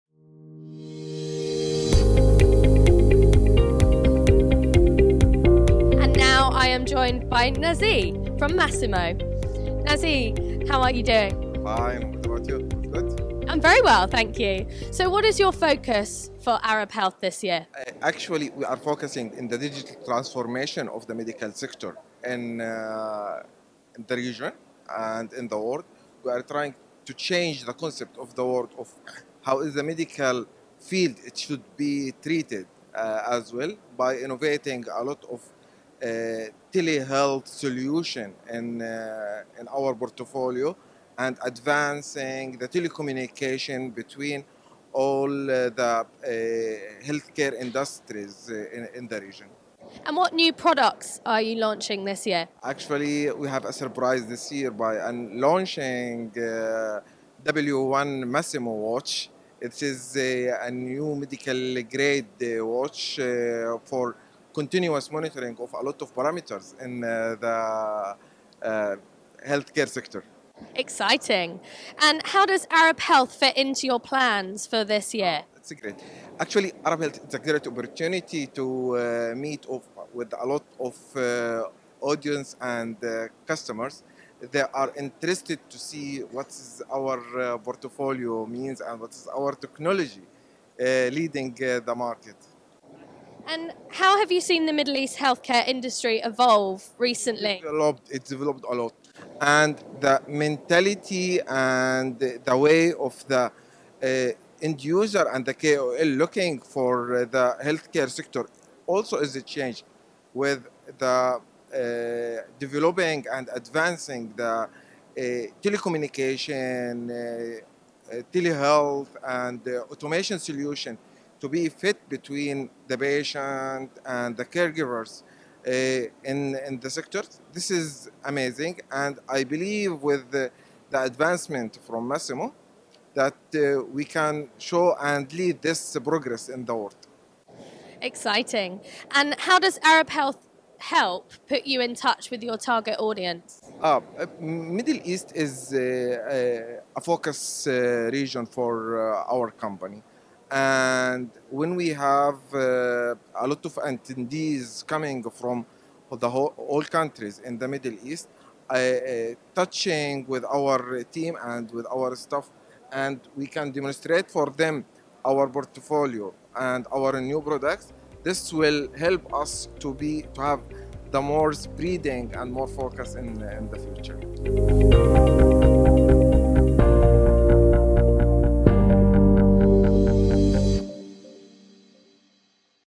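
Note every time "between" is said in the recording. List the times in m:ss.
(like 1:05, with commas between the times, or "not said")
0:43, 2:02.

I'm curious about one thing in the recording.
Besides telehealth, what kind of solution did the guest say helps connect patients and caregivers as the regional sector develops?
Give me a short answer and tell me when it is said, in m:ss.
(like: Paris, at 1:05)
Automation, at 1:59.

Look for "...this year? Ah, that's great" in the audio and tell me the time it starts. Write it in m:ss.
1:14.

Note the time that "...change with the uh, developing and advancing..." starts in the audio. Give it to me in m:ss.
1:49.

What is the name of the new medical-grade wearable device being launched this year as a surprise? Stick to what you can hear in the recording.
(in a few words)
W1.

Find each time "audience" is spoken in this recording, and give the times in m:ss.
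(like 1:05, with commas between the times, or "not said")
1:22, 2:23.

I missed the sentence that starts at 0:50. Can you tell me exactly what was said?
And what new products are you launching this year?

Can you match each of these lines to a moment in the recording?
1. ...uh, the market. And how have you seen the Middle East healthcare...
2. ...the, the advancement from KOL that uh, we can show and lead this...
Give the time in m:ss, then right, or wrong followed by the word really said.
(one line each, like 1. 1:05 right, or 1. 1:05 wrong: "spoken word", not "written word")
1. 1:31 right
2. 2:10 wrong: "Masimo", not "KOL".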